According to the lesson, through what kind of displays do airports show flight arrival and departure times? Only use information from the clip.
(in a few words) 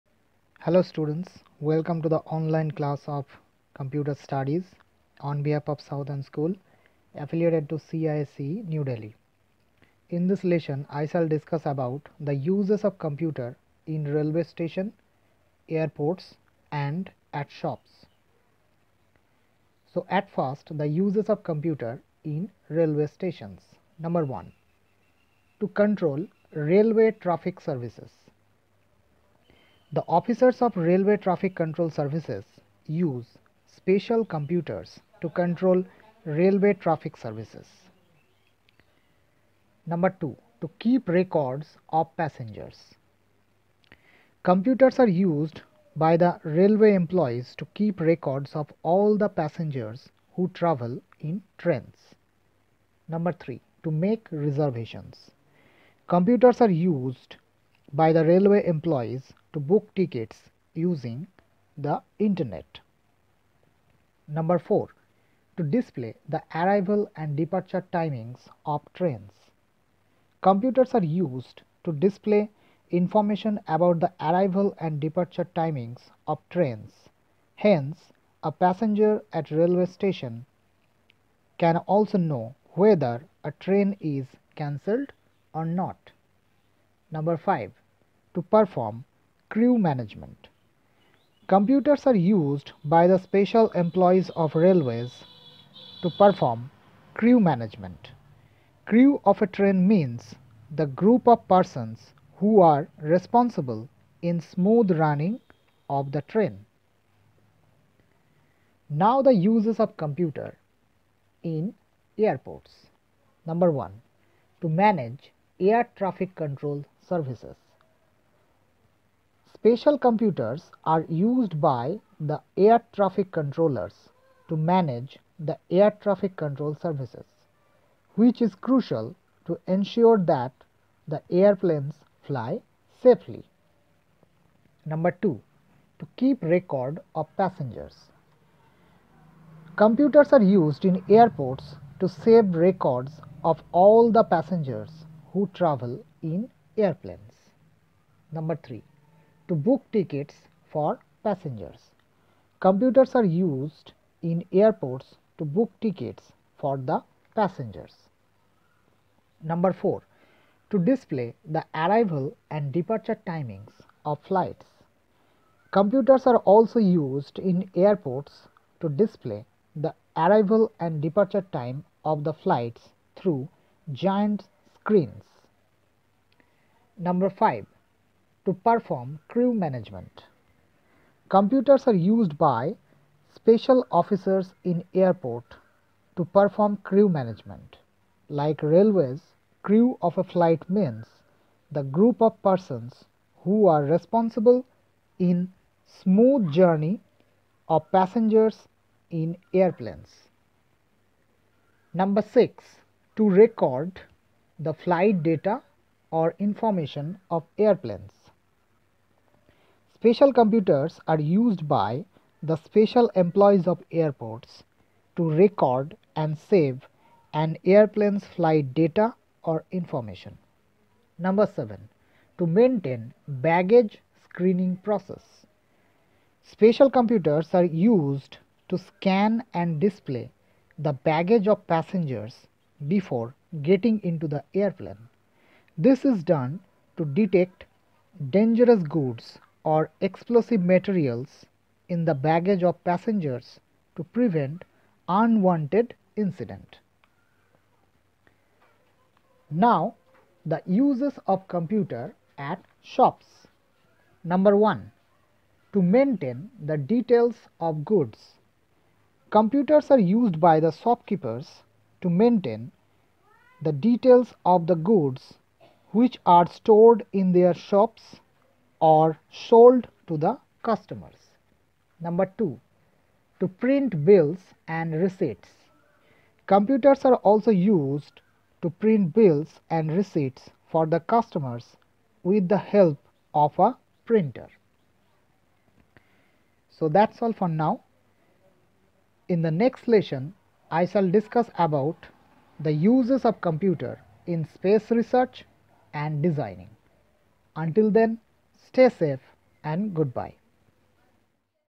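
Giant screens.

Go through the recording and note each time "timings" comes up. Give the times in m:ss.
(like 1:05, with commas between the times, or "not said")
1:07, 1:15, 2:43.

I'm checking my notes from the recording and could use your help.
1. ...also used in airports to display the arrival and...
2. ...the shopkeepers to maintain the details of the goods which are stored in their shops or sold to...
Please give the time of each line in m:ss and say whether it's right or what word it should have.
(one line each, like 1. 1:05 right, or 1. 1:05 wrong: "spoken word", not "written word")
1. 2:46 right
2. 4:20 right.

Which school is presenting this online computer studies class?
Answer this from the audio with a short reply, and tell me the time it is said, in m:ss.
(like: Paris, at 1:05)
South End School, at 0:05.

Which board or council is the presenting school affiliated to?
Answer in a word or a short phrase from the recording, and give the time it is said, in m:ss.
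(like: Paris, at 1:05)
CISCE, at 0:07.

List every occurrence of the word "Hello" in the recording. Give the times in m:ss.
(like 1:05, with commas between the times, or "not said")
0:00.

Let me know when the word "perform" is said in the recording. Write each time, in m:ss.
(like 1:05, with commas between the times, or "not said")
1:28, 1:36, 2:58, 3:06.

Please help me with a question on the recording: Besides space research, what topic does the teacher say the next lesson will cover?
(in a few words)
Designing.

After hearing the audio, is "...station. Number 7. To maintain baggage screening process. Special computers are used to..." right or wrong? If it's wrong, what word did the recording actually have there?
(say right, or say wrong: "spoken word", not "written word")
wrong: "information", not "station".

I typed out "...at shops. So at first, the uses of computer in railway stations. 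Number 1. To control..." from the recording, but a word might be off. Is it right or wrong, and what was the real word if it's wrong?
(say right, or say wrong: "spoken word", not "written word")
right.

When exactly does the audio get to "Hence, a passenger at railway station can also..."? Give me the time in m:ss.
1:17.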